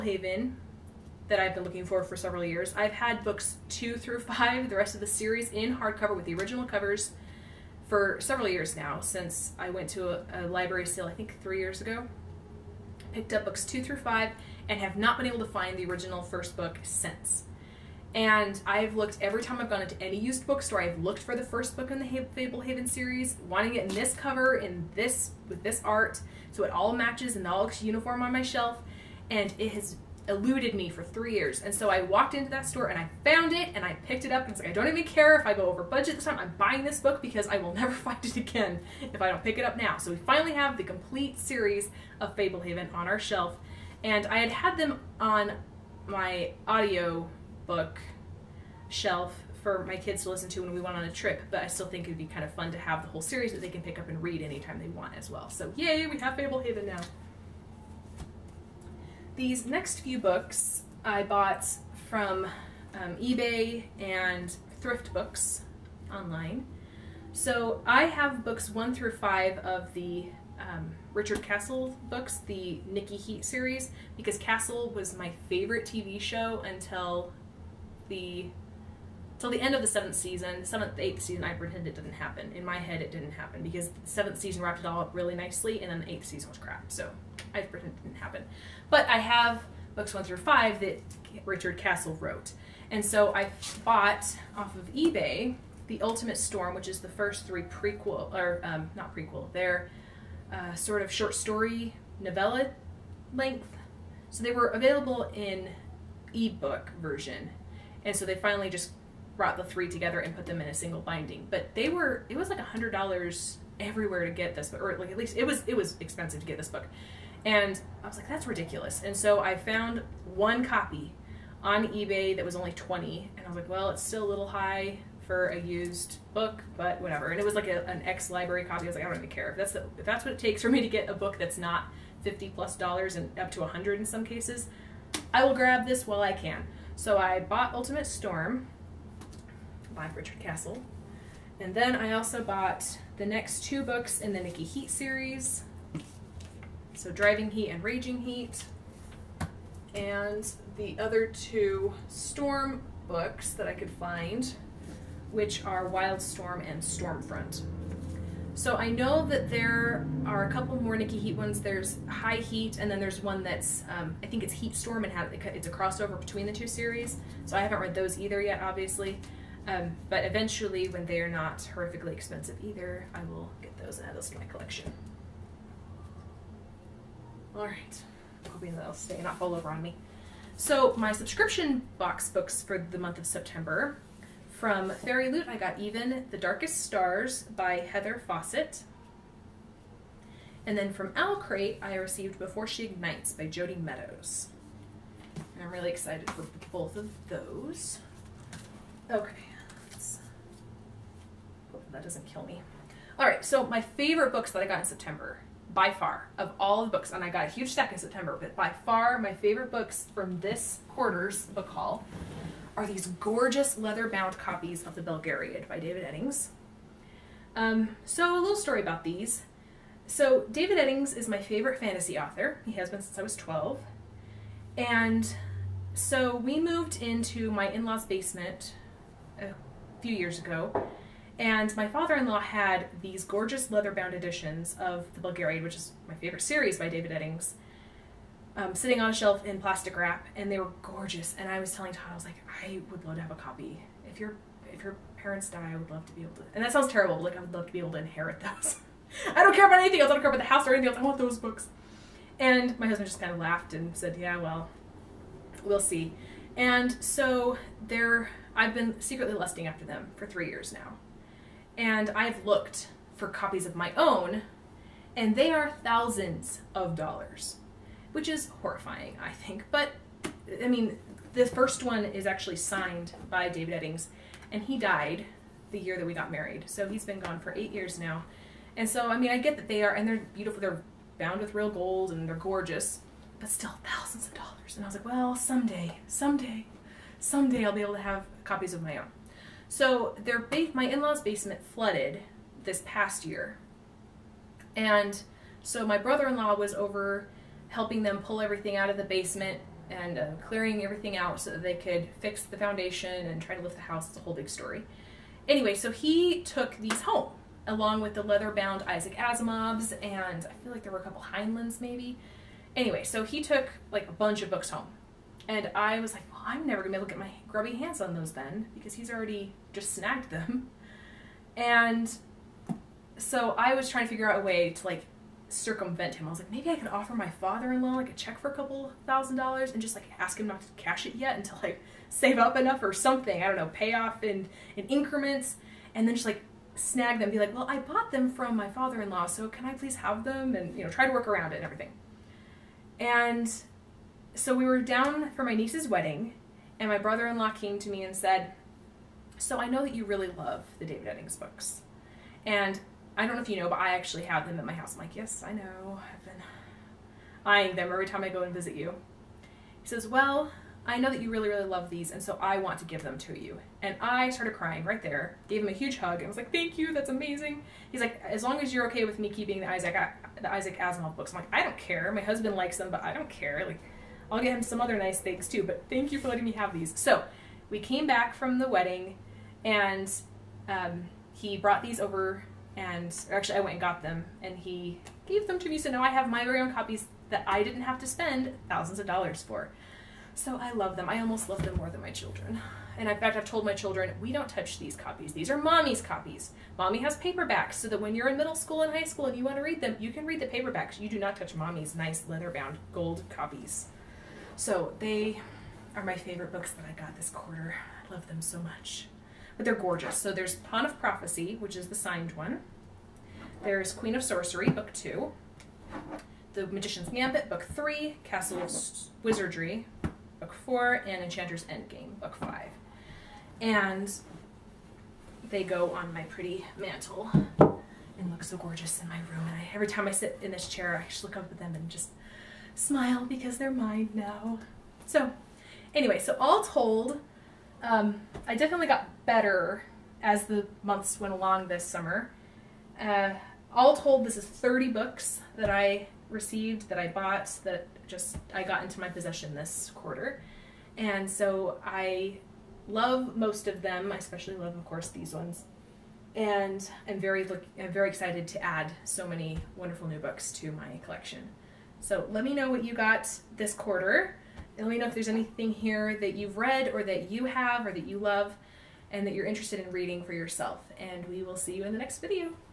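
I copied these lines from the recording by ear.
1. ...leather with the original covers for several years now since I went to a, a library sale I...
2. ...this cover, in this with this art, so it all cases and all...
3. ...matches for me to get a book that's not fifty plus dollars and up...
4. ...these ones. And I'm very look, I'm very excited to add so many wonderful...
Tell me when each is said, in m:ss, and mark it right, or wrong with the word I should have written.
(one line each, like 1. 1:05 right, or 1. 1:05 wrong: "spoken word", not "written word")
1. 0:05 wrong: "hardcover", not "leather"
2. 0:23 wrong: "matches", not "cases"
3. 2:10 wrong: "takes", not "matches"
4. 7:35 right.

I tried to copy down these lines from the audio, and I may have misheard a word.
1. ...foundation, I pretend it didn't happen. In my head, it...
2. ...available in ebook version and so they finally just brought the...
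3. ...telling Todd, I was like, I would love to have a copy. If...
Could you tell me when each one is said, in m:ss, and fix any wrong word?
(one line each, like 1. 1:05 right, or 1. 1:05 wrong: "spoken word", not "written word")
1. 1:21 wrong: "season", not "foundation"
2. 1:44 right
3. 4:01 right.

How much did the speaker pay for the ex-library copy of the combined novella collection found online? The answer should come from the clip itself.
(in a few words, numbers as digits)
$20.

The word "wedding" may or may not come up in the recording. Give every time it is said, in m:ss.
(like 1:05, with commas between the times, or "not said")
5:45, 6:18.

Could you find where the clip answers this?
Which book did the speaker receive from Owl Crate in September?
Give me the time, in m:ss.
3:12.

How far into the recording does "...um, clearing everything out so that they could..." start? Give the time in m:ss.
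5:00.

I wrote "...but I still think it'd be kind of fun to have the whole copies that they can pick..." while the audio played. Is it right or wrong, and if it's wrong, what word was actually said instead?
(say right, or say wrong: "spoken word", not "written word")
wrong: "series", not "copies".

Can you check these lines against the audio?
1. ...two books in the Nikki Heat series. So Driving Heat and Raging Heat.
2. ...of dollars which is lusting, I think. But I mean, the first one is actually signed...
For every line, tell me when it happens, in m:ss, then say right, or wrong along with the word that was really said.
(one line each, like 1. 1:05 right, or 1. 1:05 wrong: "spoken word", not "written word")
1. 2:23 right
2. 4:26 wrong: "horrifying", not "lusting".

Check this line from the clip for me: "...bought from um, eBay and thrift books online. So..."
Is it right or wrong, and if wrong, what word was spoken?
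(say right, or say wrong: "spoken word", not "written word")
right.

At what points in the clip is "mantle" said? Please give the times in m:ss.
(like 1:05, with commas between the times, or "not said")
7:06.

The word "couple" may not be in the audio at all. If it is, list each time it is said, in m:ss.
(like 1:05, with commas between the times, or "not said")
2:40, 5:11, 5:28.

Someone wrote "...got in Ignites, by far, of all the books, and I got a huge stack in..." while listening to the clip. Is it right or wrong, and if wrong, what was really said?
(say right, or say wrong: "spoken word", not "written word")
wrong: "September", not "Ignites".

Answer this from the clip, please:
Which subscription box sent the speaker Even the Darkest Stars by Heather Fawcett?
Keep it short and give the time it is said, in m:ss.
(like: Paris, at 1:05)
Fairy Loot, at 3:04.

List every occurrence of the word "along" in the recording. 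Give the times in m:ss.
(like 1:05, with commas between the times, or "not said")
5:07, 7:21.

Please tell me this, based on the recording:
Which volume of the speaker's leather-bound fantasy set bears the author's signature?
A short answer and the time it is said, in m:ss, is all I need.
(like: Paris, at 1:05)
Pawn of Prophecy, at 6:50.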